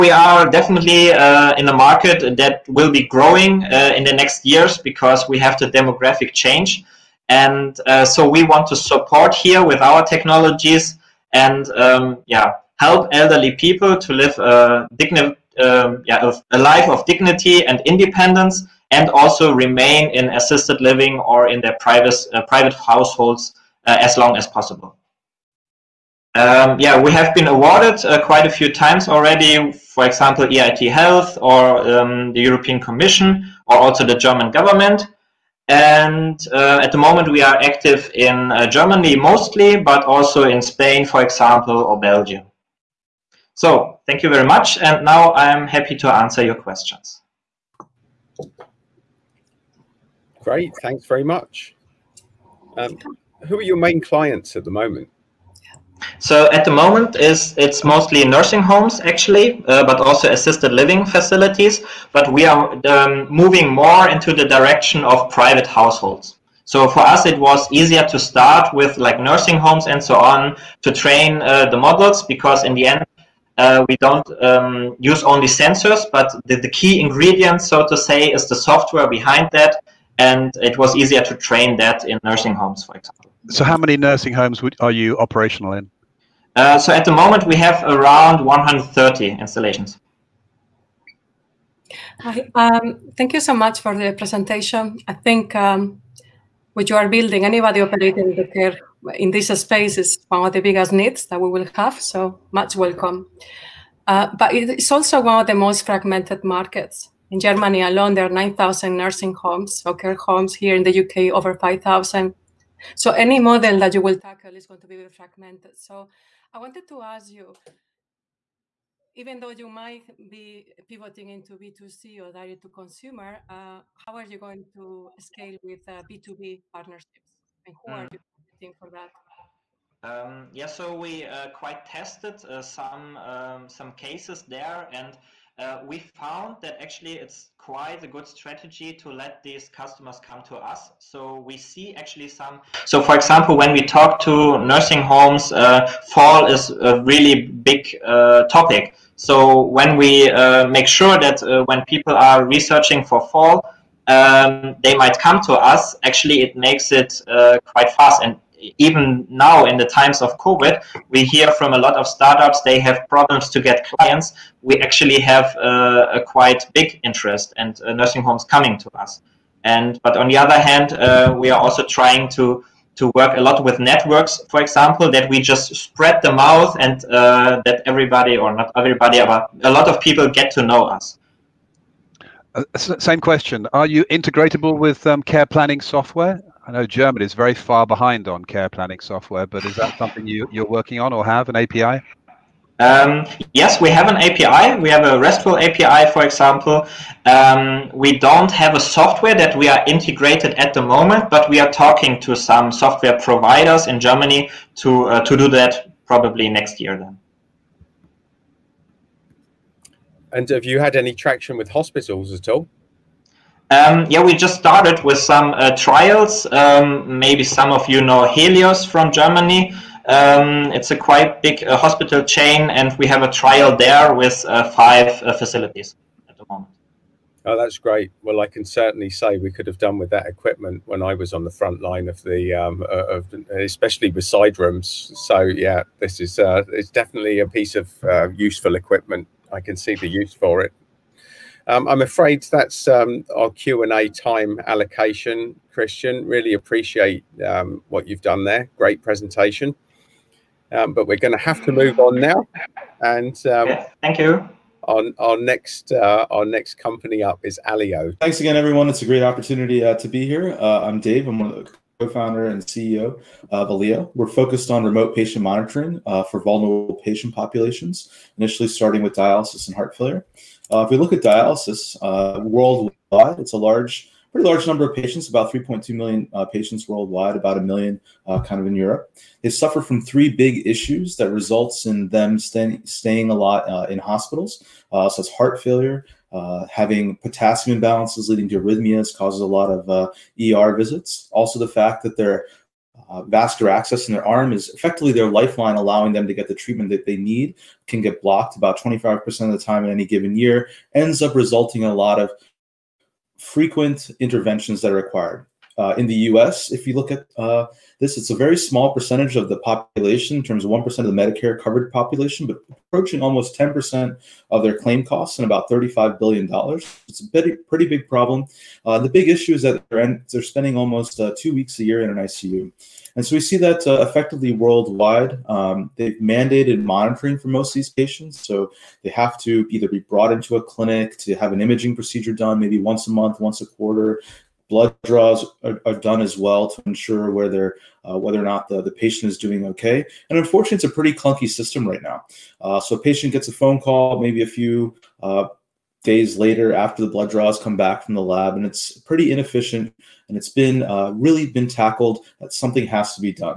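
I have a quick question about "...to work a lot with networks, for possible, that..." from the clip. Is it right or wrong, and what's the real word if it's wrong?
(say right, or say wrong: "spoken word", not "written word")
wrong: "example", not "possible".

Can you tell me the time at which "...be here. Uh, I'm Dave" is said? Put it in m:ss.
4:20.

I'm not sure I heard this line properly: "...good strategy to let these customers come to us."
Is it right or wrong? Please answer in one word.
right.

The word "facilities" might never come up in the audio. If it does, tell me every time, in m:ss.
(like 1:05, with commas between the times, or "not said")
1:01, 3:45.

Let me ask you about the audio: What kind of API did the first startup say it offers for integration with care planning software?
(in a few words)
RESTful API.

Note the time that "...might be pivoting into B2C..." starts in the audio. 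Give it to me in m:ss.
1:59.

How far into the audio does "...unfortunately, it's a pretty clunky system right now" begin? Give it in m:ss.
5:40.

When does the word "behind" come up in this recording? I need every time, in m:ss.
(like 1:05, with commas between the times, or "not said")
1:19, 3:07.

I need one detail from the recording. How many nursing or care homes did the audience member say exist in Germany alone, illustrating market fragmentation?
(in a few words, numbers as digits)
9,000.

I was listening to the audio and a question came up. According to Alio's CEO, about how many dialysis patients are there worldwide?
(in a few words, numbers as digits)
3.2 million.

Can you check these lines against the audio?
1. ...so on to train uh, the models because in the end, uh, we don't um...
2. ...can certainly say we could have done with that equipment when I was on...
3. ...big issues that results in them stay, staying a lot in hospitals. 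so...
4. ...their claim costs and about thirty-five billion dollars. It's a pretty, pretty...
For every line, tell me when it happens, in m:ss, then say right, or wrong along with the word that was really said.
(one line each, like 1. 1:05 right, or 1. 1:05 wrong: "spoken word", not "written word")
1. 1:10 right
2. 3:48 right
3. 4:40 right
4. 5:14 right.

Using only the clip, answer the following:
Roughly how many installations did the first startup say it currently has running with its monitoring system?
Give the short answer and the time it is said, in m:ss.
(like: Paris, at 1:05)
130, at 1:28.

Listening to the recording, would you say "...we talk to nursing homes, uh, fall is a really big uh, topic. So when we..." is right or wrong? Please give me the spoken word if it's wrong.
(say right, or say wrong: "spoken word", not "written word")
right.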